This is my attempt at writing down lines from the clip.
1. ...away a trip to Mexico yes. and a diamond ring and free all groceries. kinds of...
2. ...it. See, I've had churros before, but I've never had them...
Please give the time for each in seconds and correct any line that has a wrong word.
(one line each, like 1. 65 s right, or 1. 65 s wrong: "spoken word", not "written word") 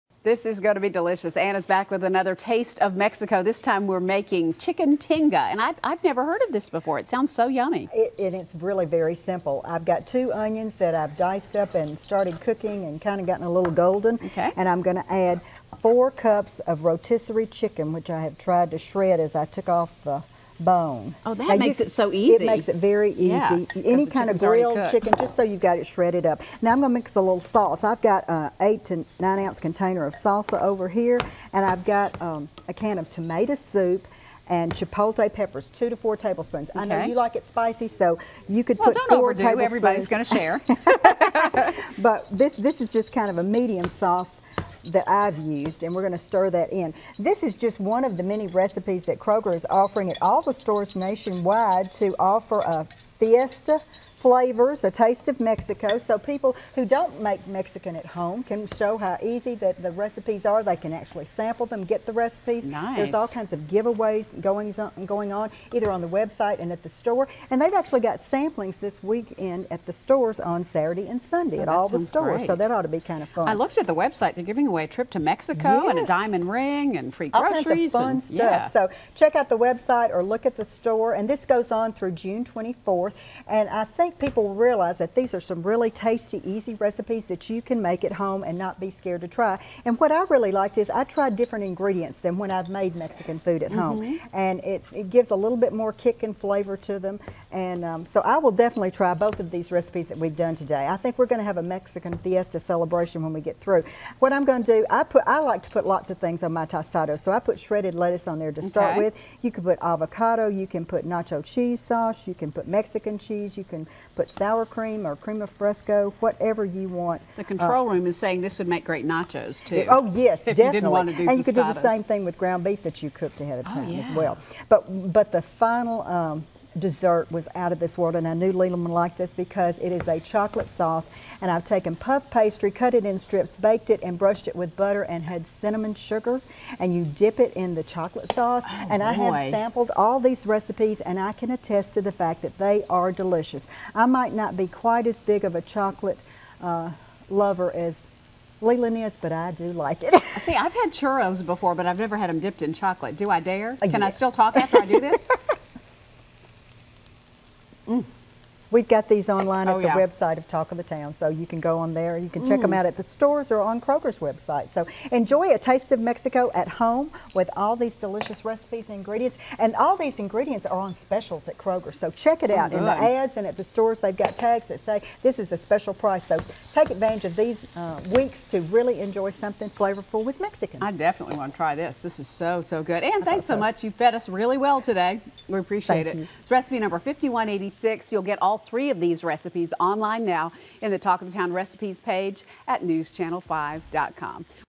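1. 74 s right
2. 150 s right.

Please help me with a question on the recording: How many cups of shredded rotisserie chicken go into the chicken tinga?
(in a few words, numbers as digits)
4.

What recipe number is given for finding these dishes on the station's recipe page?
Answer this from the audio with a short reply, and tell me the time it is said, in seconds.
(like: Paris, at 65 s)
5186, at 186 s.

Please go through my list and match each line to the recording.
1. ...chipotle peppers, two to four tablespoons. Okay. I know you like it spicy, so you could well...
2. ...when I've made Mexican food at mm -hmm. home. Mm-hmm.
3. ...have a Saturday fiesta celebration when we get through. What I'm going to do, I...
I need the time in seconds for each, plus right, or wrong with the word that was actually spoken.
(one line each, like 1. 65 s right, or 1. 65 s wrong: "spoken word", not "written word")
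1. 34 s right
2. 92 s right
3. 101 s wrong: "Mexican", not "Saturday".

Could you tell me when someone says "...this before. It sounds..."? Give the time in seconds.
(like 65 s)
6 s.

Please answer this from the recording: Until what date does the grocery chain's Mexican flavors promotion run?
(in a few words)
June 24th.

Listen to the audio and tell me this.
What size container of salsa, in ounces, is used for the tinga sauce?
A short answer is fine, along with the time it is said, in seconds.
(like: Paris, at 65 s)
8 to 9 ounces, at 28 s.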